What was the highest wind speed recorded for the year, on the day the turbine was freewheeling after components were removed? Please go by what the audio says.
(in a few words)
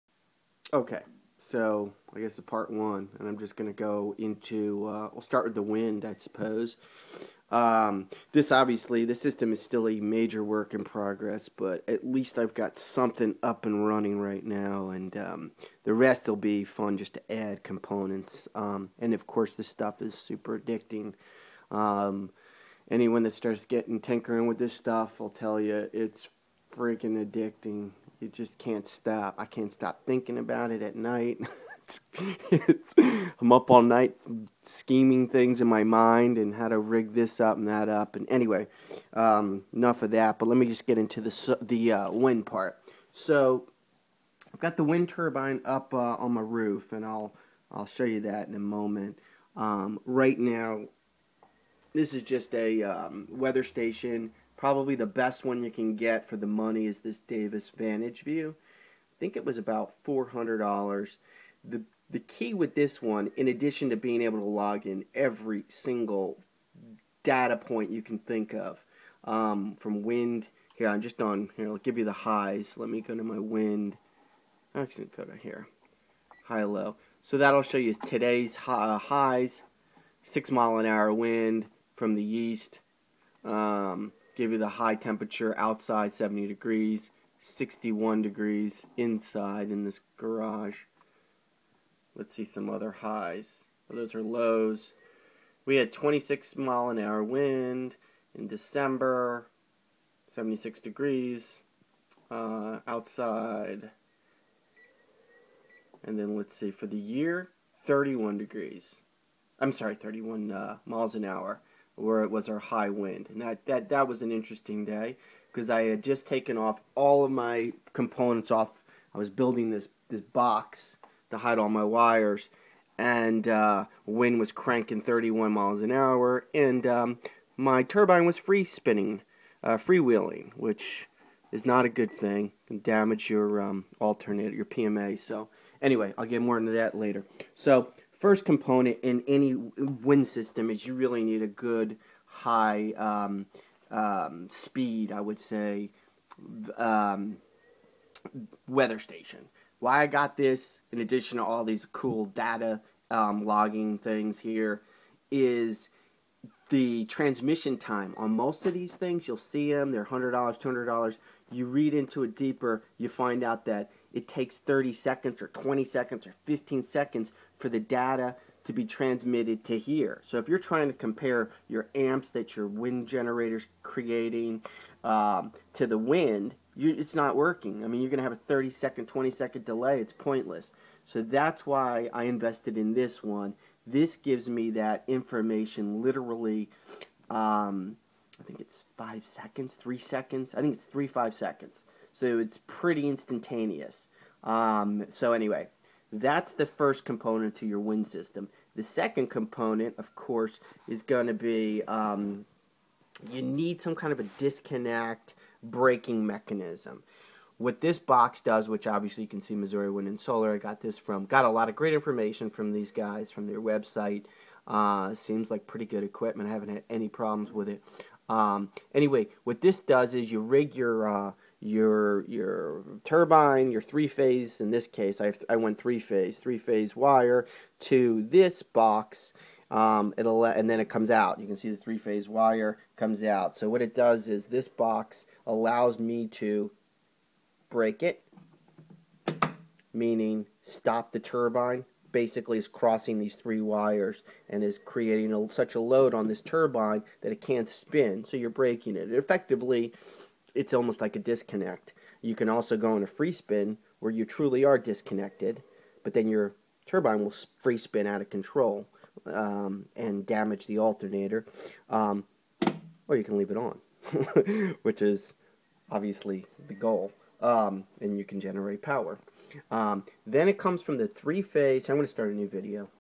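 31 mph.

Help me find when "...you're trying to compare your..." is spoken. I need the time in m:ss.
2:50.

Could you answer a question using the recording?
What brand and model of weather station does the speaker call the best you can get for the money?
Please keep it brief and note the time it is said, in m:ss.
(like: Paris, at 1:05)
Davis Vantage Vue, at 0:57.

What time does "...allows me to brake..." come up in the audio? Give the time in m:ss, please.
3:55.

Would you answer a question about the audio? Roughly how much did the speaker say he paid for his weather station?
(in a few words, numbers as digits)
$400.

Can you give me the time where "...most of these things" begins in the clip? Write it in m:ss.
2:38.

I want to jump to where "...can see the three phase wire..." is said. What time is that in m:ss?
3:51.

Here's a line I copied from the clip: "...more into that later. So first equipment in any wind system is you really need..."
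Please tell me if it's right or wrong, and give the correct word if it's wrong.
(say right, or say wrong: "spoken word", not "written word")
wrong: "component", not "equipment".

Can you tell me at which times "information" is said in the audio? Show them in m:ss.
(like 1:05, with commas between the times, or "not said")
3:05, 3:31.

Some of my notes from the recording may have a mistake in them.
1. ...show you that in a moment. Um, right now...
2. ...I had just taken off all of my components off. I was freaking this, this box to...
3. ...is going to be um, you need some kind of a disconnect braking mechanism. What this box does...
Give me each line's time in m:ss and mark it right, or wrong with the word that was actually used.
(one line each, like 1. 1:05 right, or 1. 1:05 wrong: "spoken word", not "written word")
1. 0:47 right
2. 1:55 wrong: "building", not "freaking"
3. 3:20 right.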